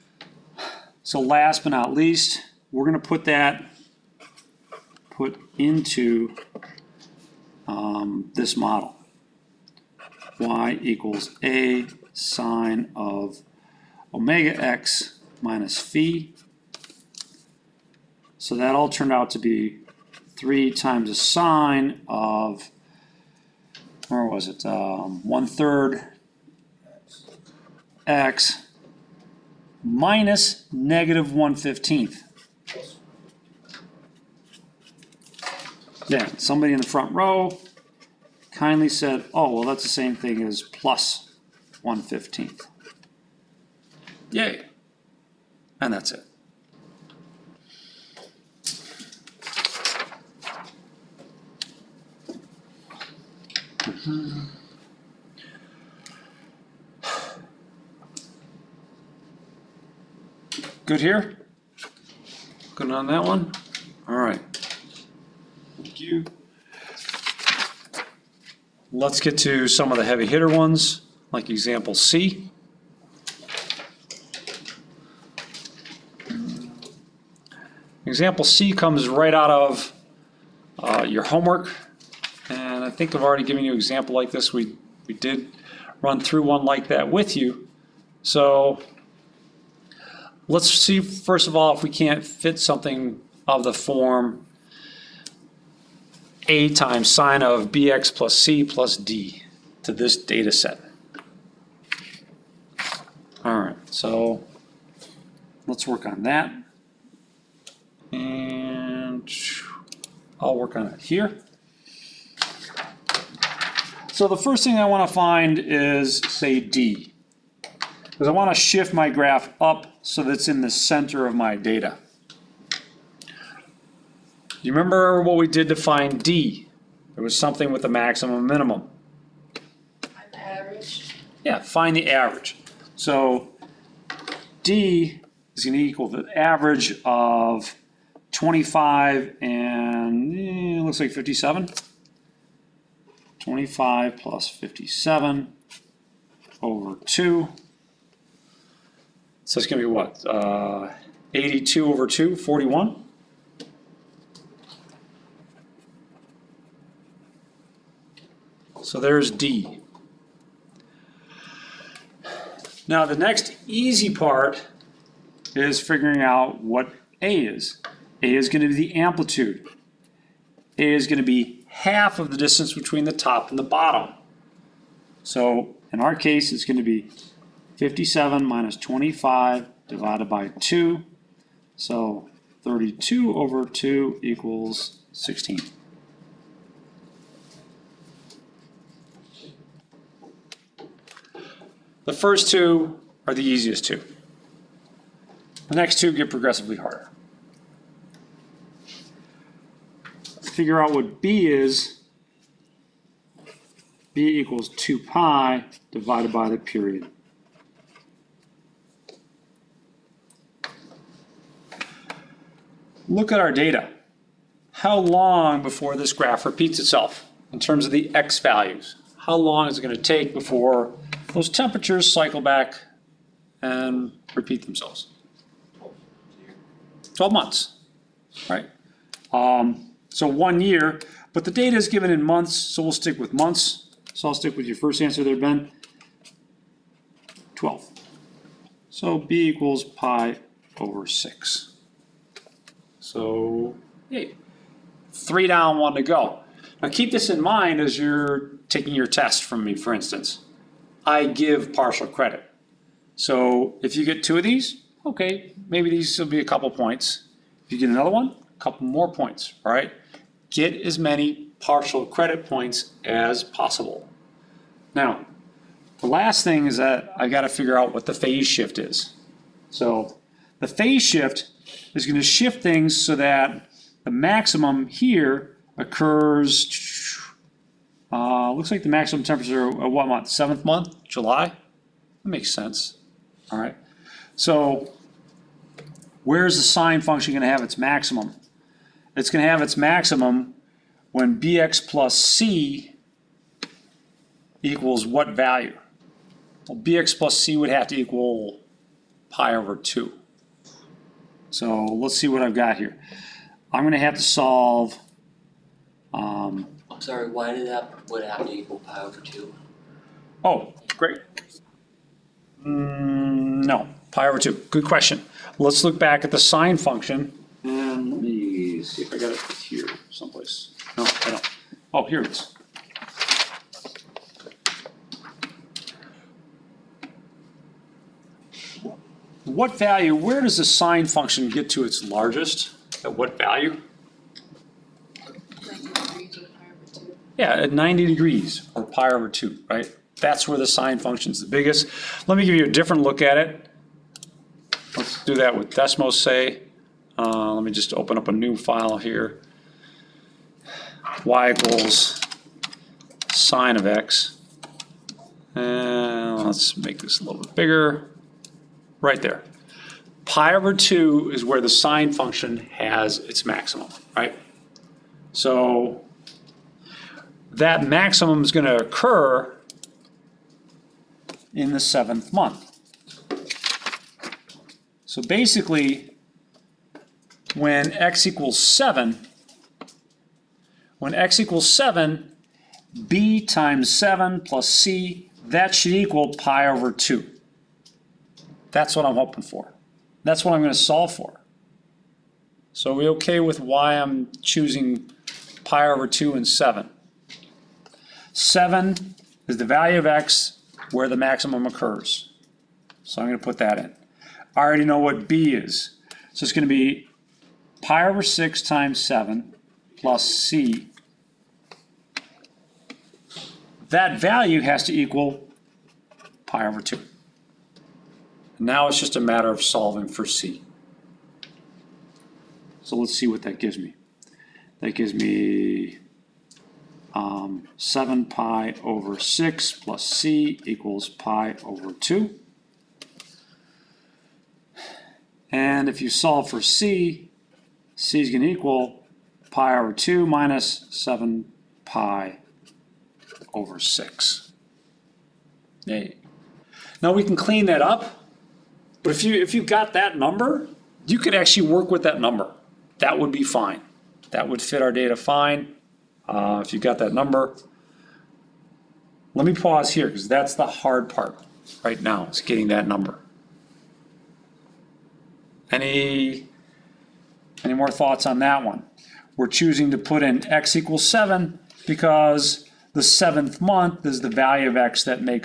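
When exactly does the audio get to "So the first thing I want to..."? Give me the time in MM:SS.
01:54.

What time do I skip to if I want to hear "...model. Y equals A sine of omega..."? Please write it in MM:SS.
00:08.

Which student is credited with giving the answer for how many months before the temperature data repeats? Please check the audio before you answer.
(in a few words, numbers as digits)
Ben.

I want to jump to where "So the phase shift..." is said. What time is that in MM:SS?
04:29.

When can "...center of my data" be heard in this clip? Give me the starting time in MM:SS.
02:00.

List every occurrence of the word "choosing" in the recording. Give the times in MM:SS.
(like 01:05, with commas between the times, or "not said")
06:34, 07:49.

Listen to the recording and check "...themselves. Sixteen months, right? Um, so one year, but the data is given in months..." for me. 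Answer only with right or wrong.
wrong.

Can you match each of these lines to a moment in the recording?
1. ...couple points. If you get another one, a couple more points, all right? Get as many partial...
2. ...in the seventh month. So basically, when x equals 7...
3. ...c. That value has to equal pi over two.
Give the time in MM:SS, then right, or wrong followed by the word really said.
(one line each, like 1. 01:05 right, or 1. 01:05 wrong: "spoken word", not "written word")
1. 04:16 right
2. 06:11 right
3. 06:50 right.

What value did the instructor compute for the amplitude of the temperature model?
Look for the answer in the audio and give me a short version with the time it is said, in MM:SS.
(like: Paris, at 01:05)
16, at 03:05.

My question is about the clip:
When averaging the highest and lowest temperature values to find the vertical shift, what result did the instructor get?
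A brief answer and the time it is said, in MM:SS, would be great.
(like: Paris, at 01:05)
41, at 02:32.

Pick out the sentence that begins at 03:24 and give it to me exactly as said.
b equals 2 pi divided by the period.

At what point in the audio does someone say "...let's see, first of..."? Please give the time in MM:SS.
01:30.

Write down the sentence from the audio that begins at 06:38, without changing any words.
Seven is the value of x where the maximum occurs.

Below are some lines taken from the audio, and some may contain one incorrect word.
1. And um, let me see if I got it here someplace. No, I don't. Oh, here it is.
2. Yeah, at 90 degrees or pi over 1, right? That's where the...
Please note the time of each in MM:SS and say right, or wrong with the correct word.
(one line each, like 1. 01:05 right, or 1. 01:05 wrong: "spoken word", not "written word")
1. 05:17 right
2. 05:37 wrong: "2", not "1".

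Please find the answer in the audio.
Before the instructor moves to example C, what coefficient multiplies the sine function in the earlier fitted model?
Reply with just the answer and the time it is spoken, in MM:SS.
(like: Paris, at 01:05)
3, at 00:20.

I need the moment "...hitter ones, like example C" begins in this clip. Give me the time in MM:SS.
01:10.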